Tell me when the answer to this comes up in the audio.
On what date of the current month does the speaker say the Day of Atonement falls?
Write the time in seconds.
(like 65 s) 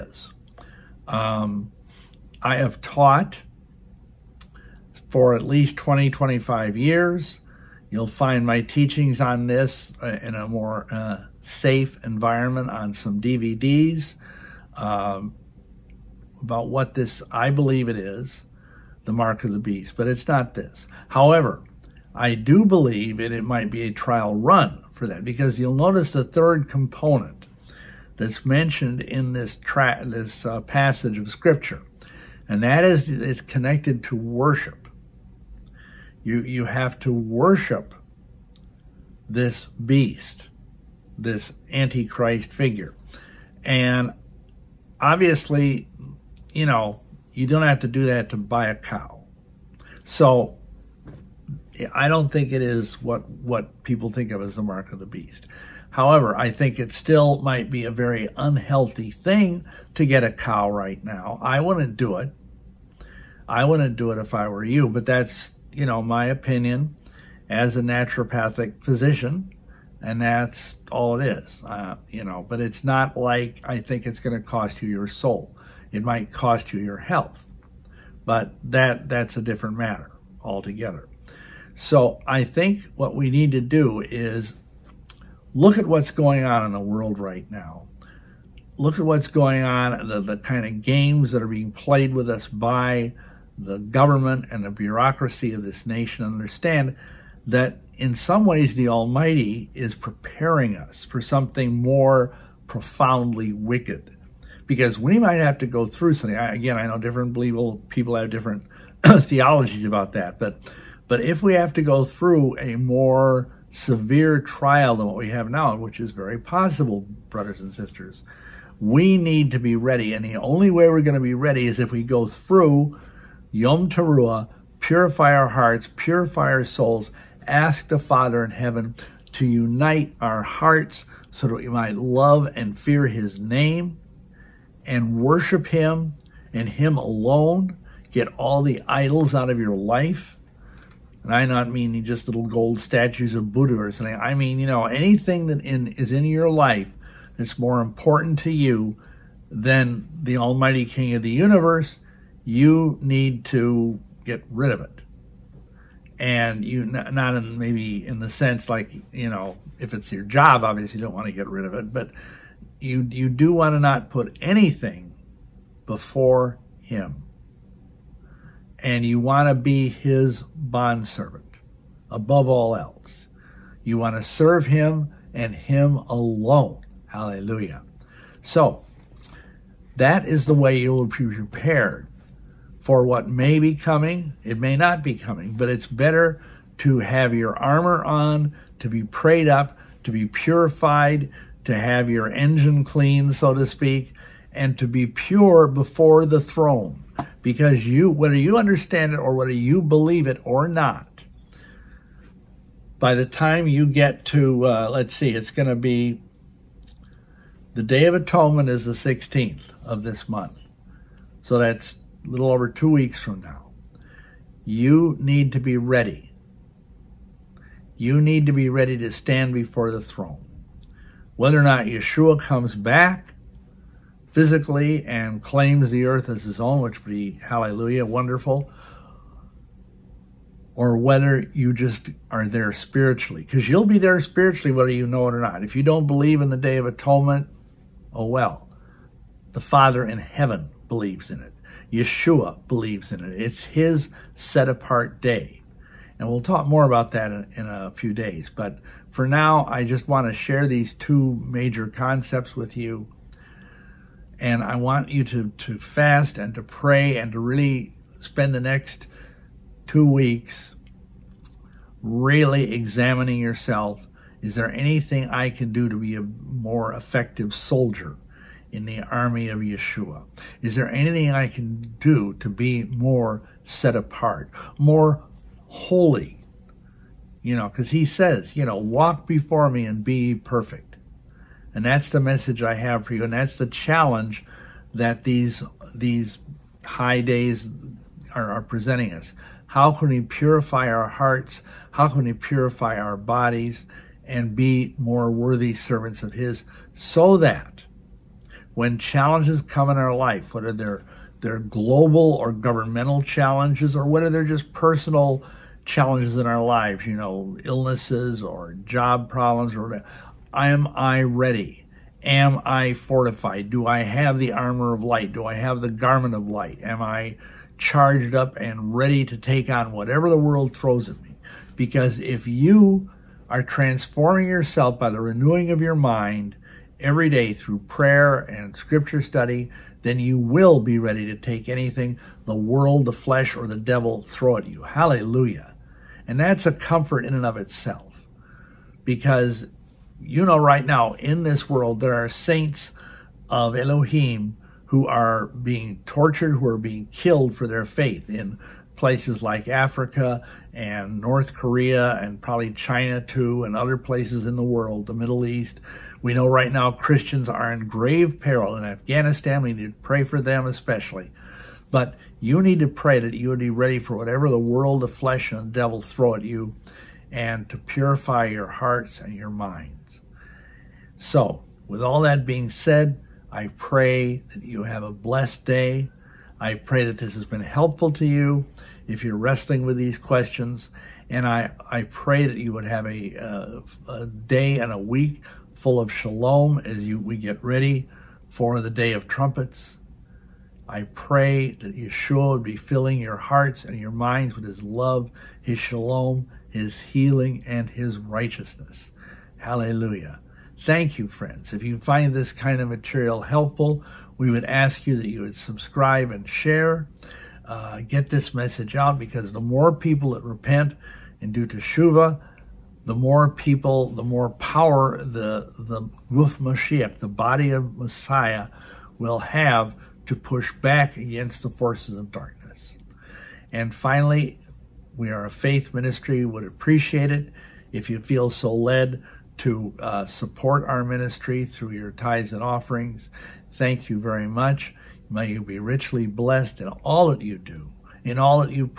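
208 s.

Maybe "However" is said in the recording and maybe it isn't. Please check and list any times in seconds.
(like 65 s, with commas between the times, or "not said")
21 s, 55 s.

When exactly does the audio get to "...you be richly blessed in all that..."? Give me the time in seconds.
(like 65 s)
435 s.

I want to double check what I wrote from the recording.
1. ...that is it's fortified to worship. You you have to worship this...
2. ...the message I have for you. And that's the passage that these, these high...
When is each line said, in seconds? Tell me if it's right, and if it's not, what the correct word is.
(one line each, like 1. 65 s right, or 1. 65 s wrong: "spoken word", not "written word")
1. 32 s wrong: "connected", not "fortified"
2. 282 s wrong: "challenge", not "passage".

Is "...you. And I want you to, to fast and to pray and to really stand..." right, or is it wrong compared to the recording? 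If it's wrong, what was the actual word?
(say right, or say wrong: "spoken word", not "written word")
wrong: "spend", not "stand".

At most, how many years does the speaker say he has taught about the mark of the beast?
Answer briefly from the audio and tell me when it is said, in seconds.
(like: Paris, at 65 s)
25, at 6 s.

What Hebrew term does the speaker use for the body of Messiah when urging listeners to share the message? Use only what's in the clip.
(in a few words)
Guf Mashiach.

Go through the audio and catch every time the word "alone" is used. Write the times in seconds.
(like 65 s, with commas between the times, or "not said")
136 s, 175 s.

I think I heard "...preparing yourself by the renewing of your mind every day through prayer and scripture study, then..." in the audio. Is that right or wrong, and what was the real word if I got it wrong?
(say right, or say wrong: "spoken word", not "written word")
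wrong: "transforming", not "preparing".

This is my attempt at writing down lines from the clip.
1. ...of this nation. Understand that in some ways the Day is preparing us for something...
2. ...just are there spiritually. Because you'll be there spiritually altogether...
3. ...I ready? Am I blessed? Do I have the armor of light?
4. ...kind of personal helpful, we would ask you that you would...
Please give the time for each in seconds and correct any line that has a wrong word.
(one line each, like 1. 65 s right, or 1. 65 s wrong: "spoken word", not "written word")
1. 95 s wrong: "Almighty", not "Day"
2. 231 s wrong: "whether", not "altogether"
3. 310 s wrong: "fortified", not "blessed"
4. 402 s wrong: "material", not "personal".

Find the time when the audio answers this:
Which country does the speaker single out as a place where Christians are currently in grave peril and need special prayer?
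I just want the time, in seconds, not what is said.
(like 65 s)
358 s.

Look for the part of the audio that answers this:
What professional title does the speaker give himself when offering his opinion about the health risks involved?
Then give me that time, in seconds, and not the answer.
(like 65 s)
67 s.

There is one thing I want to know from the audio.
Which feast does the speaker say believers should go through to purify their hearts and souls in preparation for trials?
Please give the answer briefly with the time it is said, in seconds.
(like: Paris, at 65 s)
Yom Teruah, at 123 s.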